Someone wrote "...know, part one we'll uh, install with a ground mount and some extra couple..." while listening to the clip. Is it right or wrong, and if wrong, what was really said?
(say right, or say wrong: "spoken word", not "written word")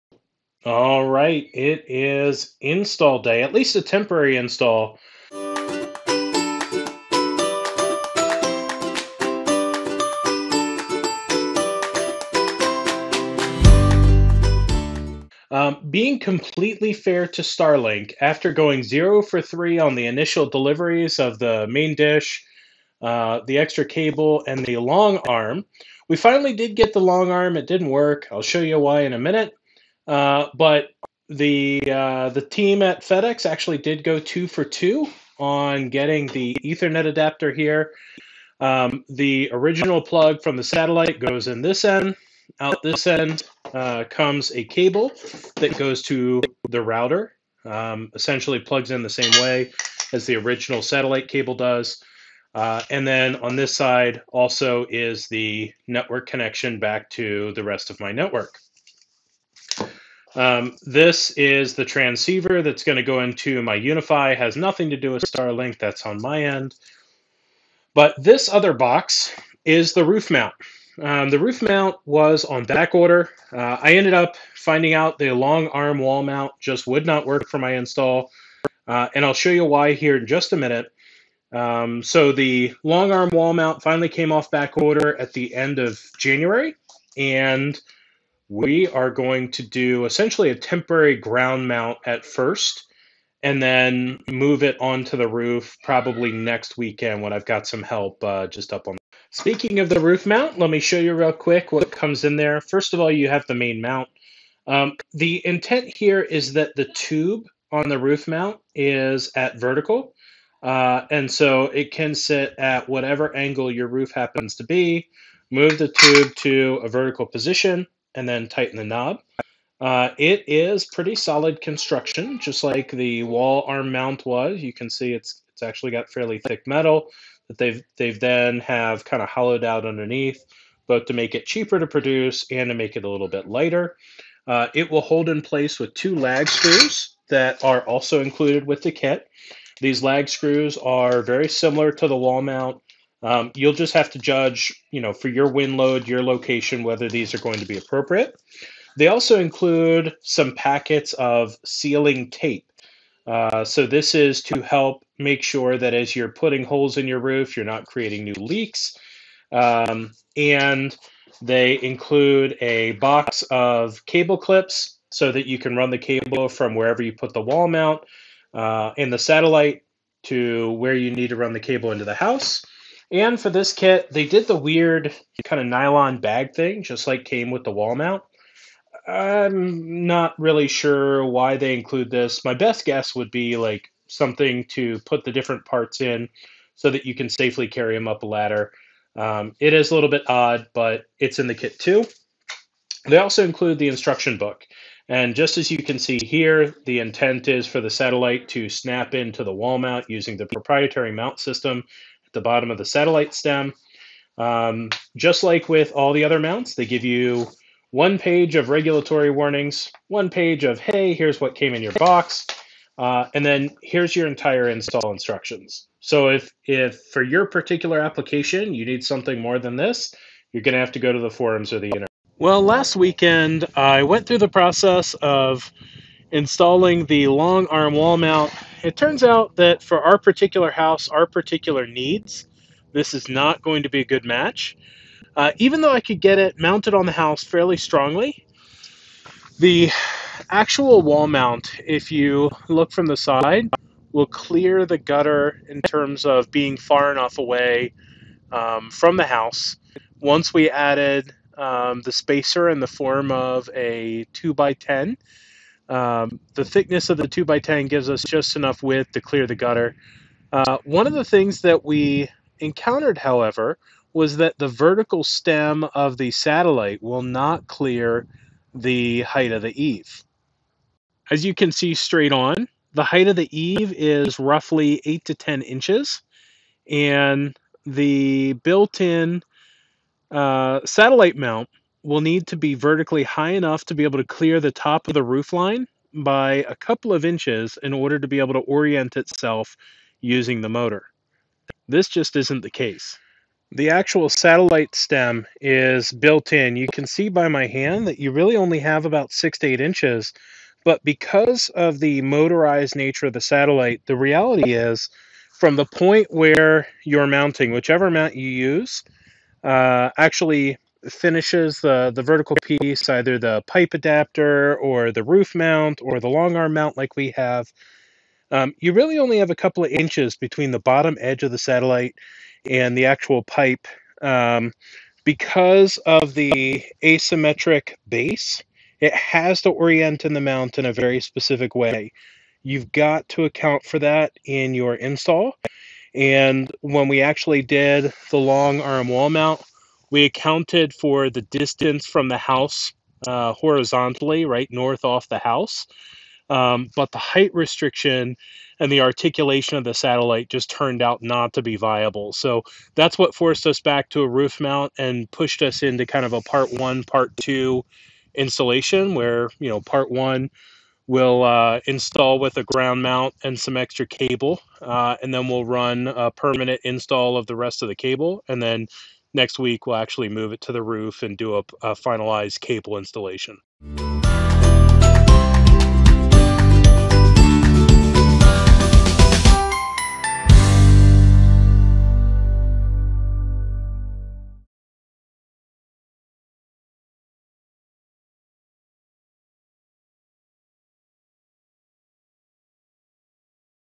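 wrong: "cable", not "couple".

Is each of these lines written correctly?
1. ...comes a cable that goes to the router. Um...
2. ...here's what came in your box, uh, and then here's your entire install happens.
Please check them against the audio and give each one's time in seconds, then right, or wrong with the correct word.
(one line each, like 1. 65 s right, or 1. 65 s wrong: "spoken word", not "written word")
1. 44 s right
2. 211 s wrong: "instructions", not "happens".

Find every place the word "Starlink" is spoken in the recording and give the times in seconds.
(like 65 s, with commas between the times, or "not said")
17 s, 65 s.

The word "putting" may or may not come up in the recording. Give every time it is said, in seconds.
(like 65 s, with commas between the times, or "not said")
156 s.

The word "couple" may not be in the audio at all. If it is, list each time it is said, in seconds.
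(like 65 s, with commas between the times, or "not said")
286 s, 319 s.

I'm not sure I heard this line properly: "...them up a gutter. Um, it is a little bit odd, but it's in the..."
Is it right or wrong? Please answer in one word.
wrong.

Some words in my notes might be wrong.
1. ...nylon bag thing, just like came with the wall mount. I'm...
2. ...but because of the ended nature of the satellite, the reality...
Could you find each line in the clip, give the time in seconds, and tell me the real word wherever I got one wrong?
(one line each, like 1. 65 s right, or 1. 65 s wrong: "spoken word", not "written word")
1. 175 s right
2. 300 s wrong: "motorized", not "ended".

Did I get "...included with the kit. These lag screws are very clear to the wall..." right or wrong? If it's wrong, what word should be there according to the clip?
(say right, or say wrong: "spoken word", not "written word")
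wrong: "similar", not "clear".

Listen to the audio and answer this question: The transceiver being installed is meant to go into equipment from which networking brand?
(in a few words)
UniFi.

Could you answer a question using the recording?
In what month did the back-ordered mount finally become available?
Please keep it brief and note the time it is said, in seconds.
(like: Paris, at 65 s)
January, at 86 s.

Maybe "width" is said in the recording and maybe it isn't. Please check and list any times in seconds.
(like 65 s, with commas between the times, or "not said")
258 s.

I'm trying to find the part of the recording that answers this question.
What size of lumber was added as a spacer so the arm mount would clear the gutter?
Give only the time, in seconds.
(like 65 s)
254 s.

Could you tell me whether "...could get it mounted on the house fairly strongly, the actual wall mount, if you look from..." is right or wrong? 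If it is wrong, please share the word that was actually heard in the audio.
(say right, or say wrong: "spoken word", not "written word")
right.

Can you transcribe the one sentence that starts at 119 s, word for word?
Uh, it is pretty solid construction, just like the wall arm mount was.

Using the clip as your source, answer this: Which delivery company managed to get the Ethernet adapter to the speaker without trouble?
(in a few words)
FedEx.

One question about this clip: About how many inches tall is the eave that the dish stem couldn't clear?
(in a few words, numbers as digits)
8 to 10 inches.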